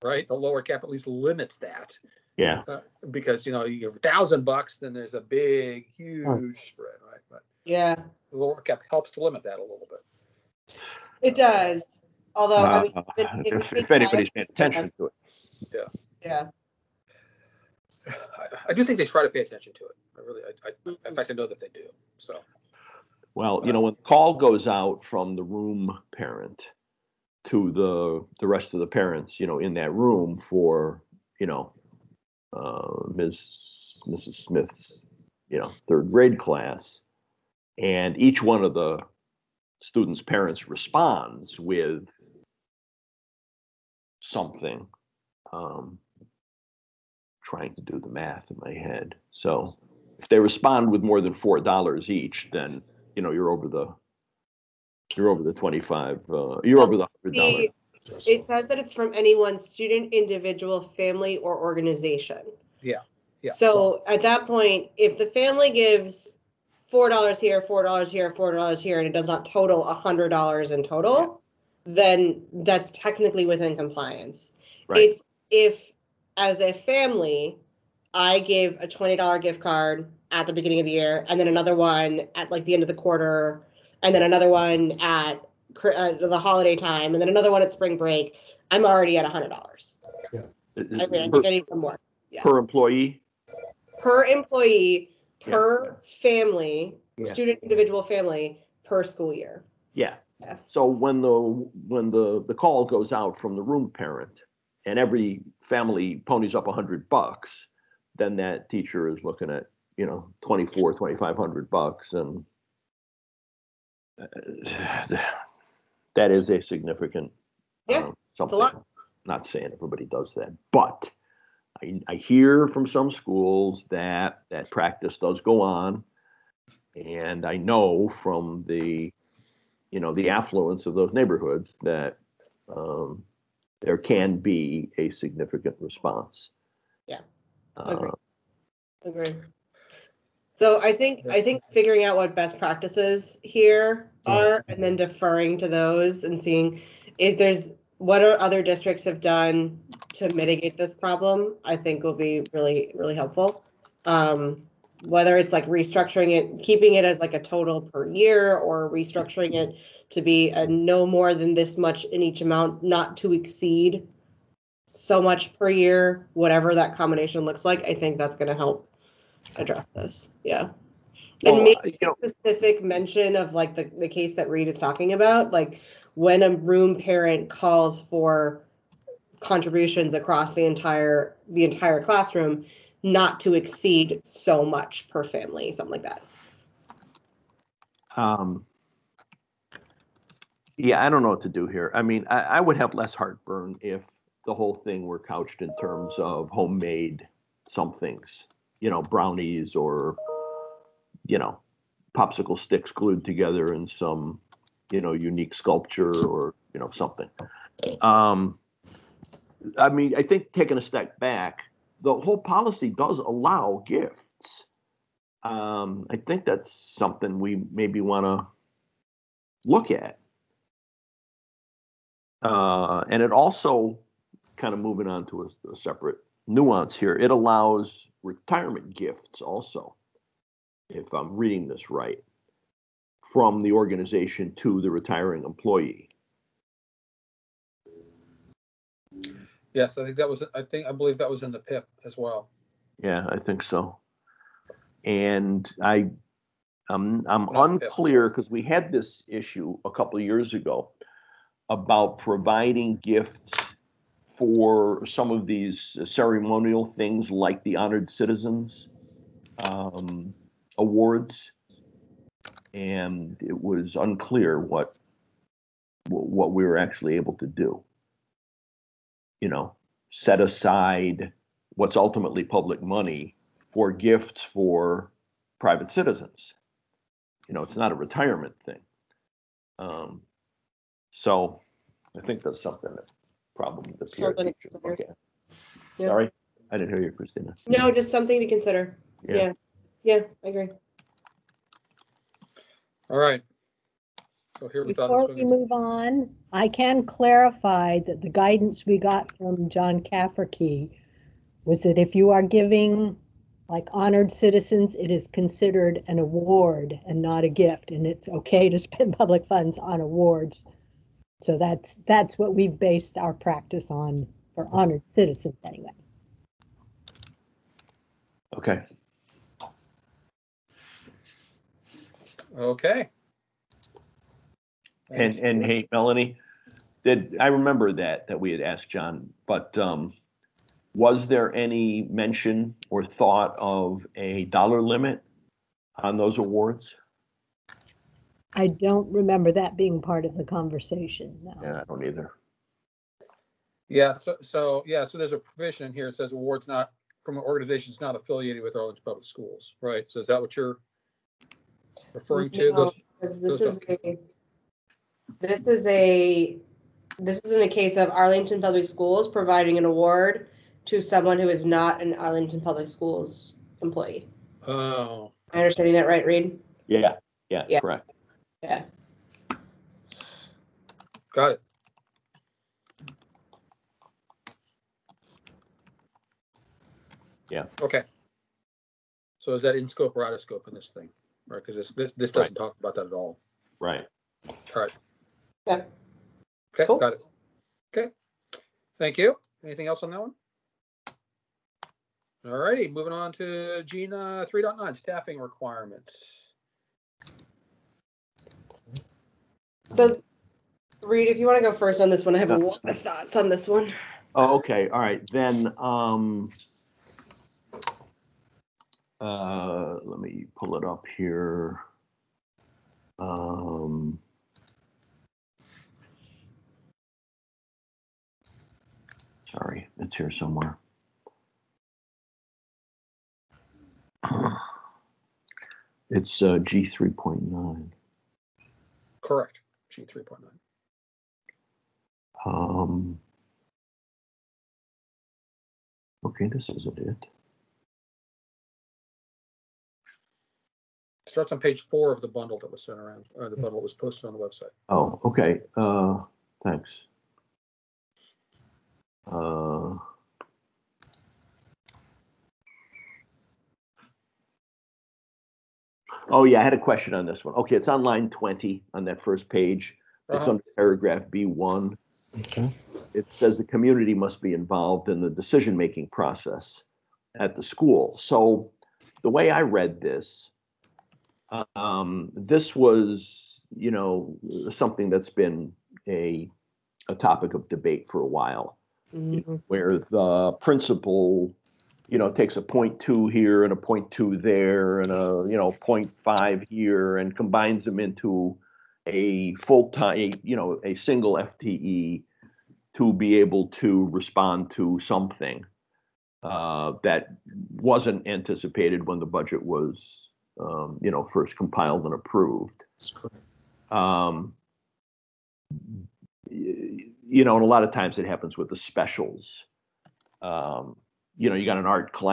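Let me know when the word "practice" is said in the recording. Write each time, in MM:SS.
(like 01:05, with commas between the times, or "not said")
02:04, 02:22, 05:13.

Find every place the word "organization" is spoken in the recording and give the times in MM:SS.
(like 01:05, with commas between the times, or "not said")
01:01, 03:53, 05:47.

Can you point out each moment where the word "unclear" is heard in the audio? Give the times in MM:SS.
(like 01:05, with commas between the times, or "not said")
04:07, 04:23.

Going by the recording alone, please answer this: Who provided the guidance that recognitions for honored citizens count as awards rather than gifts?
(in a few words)
John Cafferky.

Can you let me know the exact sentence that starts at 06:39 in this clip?
So, Reid, if you want to go first on this one, I have a lot of thoughts on this one.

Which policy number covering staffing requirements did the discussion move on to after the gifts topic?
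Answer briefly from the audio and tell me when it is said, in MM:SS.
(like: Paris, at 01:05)
G3.9, at 06:33.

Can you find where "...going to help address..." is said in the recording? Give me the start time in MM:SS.
02:48.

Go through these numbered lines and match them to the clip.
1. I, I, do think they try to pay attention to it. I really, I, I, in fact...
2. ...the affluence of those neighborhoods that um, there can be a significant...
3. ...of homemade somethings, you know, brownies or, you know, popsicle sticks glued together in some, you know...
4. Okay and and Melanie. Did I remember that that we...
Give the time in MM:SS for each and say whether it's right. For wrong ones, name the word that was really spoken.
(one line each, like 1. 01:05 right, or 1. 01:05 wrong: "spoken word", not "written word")
1. 00:18 right
2. 02:10 right
3. 03:16 right
4. 05:22 right.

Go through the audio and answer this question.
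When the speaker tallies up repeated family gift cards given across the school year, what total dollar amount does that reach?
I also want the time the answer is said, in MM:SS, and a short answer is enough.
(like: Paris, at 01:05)
$100, at 01:28.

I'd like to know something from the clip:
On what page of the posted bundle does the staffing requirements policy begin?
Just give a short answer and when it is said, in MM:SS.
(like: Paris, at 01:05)
page four, at 07:21.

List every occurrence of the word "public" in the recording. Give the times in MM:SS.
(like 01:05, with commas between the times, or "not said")
04:32, 05:09, 05:49, 05:58, 06:02.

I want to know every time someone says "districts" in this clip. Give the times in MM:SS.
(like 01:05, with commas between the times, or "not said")
02:28.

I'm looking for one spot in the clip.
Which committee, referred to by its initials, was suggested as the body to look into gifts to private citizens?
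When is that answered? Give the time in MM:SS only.
04:44.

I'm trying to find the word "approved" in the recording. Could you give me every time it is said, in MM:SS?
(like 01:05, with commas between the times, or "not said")
08:22.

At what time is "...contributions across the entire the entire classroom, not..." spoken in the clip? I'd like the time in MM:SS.
02:59.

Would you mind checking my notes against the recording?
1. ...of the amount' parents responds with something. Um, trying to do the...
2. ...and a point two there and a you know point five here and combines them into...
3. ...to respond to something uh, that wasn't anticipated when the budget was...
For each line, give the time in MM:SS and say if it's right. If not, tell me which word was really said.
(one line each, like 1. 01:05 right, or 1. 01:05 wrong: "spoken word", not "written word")
1. 00:38 wrong: "students", not "amount"
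2. 08:03 right
3. 08:13 right.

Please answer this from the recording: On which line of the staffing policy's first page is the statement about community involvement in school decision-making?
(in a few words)
line 20.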